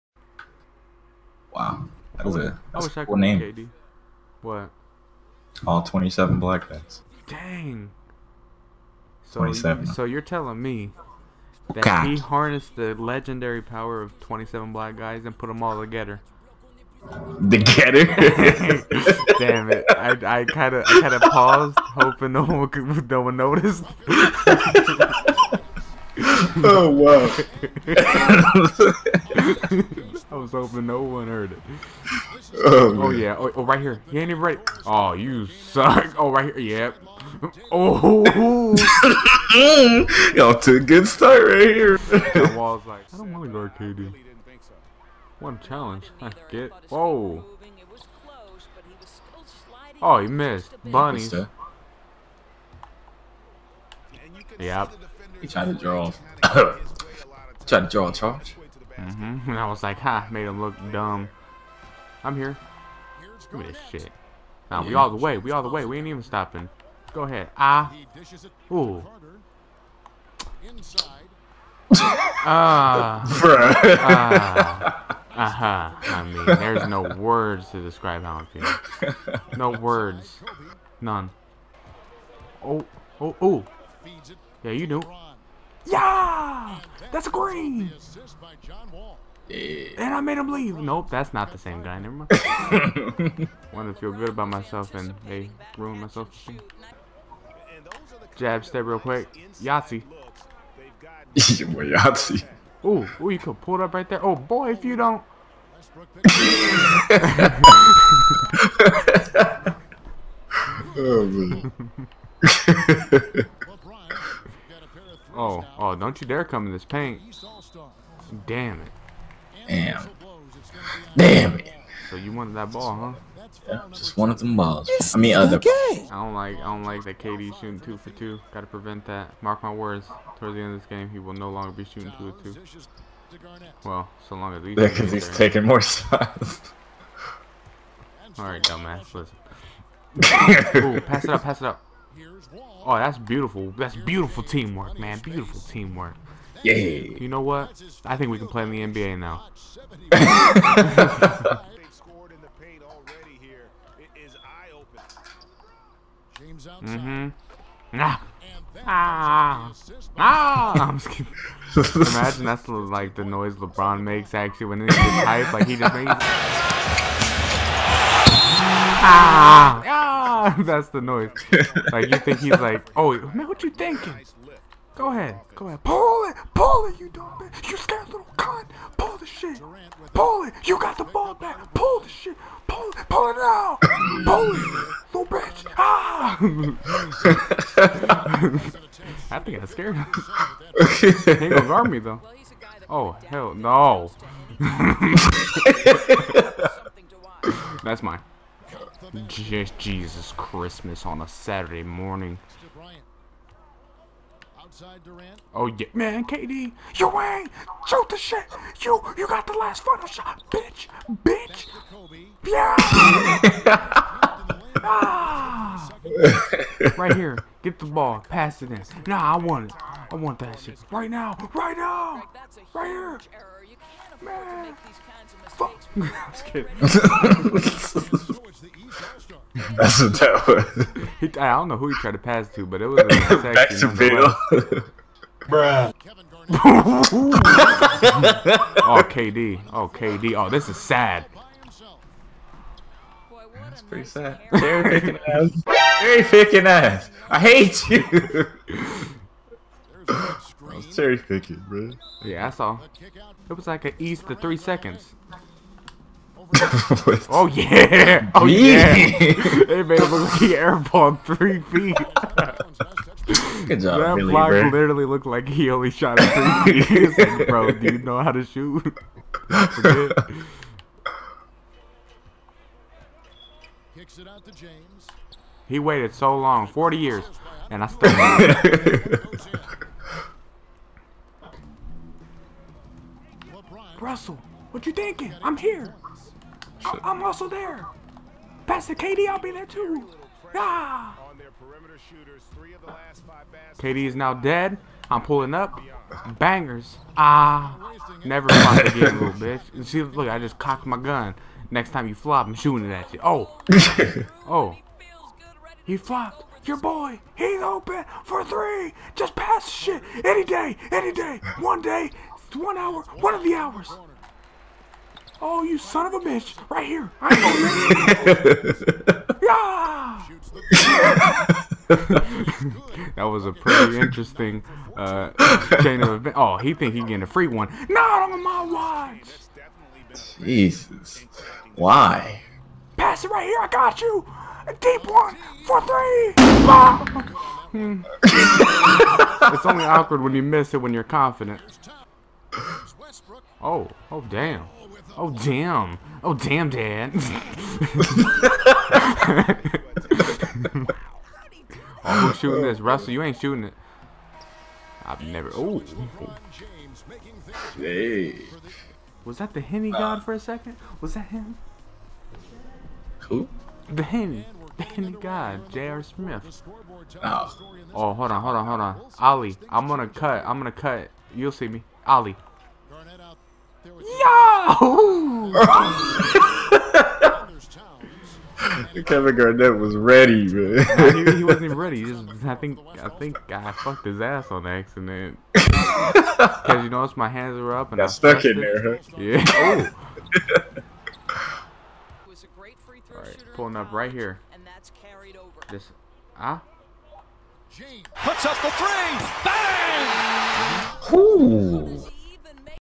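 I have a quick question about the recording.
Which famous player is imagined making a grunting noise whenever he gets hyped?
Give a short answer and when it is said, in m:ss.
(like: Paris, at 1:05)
LeBron, at 2:43.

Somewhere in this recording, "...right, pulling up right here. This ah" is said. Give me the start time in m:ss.
6:33.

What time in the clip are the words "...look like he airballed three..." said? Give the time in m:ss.
4:20.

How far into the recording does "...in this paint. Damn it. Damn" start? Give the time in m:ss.
1:56.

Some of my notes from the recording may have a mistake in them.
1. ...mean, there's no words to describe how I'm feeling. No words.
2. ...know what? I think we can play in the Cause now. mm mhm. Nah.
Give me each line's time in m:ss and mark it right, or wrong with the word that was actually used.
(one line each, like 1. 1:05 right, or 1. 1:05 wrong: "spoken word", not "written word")
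1. 1:16 right
2. 2:27 wrong: "NBA", not "Cause".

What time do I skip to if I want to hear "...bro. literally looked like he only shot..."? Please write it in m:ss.
4:24.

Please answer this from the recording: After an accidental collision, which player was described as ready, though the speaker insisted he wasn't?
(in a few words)
Kevin Garnett.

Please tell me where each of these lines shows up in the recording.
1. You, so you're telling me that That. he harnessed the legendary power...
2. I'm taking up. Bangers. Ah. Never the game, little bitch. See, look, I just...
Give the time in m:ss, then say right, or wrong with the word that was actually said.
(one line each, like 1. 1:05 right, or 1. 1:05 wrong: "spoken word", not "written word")
1. 0:09 wrong: "God", not "That"
2. 4:55 wrong: "pulling", not "taking".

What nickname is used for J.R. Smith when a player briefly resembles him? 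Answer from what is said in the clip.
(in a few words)
The Henny God.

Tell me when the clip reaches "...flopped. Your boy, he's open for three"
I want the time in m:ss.
5:05.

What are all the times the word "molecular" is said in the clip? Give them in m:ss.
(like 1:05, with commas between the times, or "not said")
not said.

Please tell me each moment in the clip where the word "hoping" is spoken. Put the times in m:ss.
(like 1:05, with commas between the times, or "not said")
0:21, 0:30.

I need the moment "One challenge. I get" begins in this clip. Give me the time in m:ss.
0:45.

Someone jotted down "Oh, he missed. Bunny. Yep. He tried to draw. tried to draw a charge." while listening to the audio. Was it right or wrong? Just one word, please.
right.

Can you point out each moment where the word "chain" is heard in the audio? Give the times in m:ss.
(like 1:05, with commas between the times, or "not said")
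5:25.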